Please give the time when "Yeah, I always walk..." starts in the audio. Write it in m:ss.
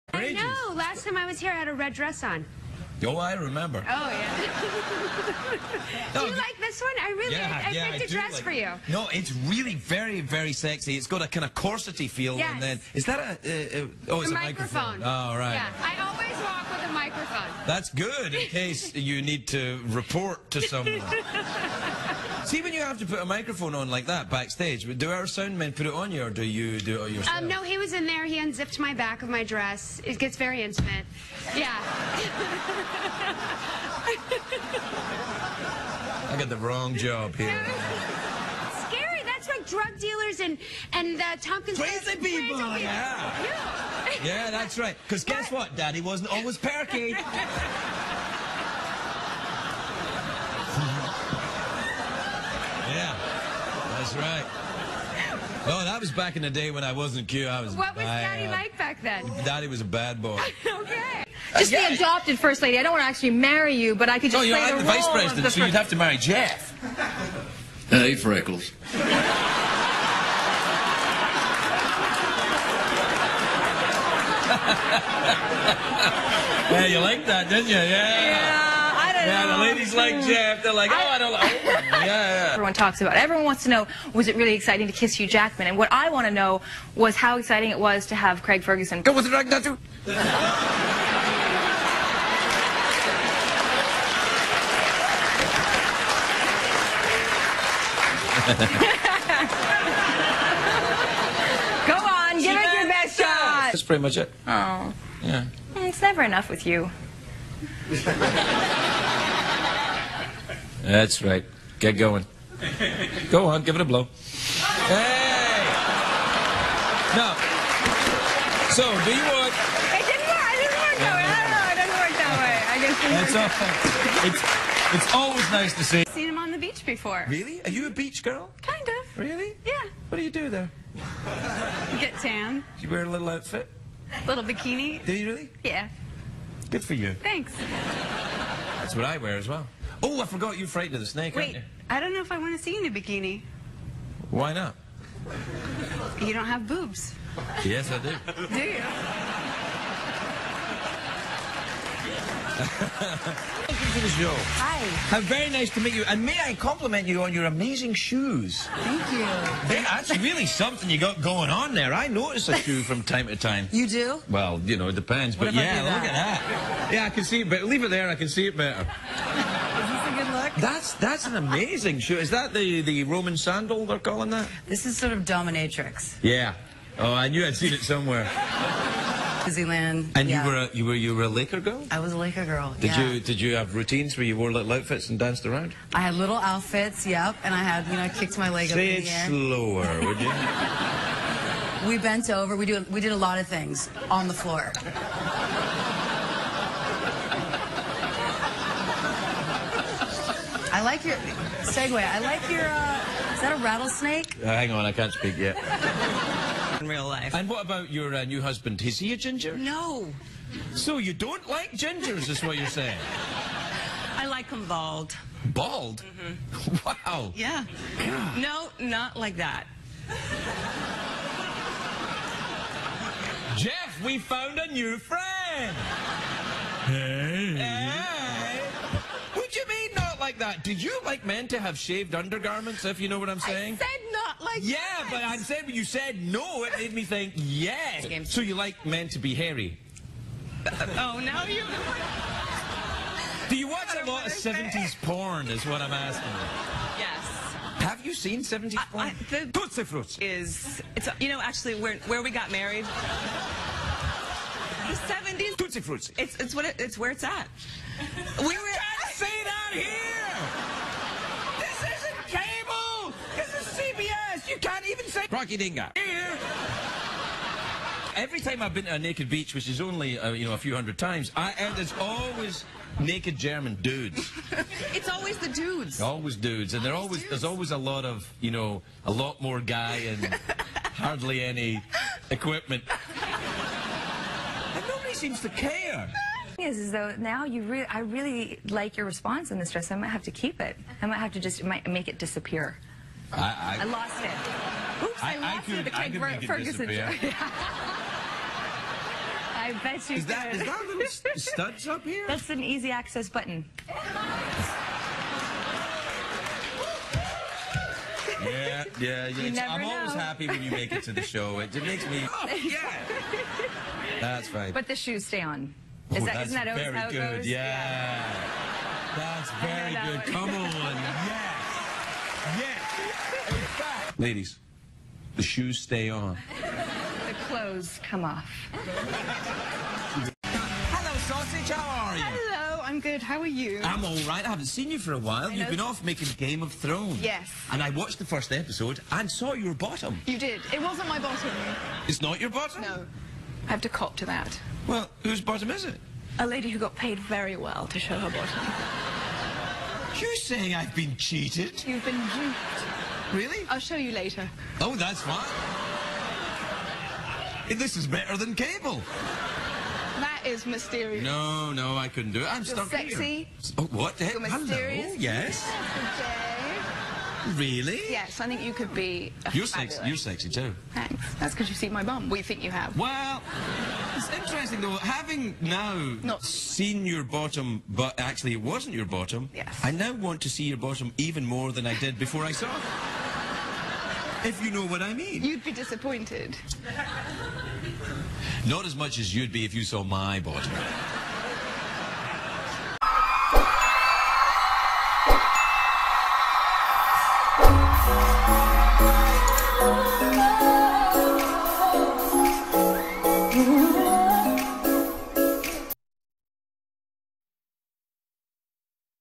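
0:15.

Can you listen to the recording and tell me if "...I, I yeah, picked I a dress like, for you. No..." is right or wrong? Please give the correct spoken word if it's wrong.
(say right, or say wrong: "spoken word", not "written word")
right.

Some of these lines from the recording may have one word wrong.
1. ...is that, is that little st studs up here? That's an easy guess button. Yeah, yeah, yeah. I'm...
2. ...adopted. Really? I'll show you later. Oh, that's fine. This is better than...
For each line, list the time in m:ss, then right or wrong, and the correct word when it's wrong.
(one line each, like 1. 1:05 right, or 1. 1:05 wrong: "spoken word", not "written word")
1. 5:00 wrong: "access", not "guess"
2. 5:52 wrong: "duped", not "adopted".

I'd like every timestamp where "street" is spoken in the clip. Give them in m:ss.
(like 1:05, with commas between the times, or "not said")
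not said.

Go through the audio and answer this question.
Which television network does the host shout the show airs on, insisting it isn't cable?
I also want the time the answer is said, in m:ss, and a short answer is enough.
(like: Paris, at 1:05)
CBS, at 4:23.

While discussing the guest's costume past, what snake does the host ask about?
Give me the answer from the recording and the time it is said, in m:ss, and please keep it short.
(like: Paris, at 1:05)
Rattlesnake, at 3:23.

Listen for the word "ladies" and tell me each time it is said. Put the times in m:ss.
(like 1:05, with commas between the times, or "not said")
1:19, 5:24.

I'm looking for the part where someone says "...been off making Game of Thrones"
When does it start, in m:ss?
5:35.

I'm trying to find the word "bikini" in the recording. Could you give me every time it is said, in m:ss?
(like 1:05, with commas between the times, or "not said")
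2:14, 2:22.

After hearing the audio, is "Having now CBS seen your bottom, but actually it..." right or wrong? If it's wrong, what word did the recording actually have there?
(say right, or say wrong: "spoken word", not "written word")
wrong: "Not", not "CBS".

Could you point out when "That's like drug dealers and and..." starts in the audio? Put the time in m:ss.
0:39.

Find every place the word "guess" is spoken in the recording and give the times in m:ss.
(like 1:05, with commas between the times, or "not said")
0:45, 2:04.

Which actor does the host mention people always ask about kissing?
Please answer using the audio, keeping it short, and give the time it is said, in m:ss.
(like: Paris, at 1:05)
Hugh Jackman, at 1:25.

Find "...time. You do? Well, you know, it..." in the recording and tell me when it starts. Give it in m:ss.
2:43.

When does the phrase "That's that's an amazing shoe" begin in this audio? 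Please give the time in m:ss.
2:50.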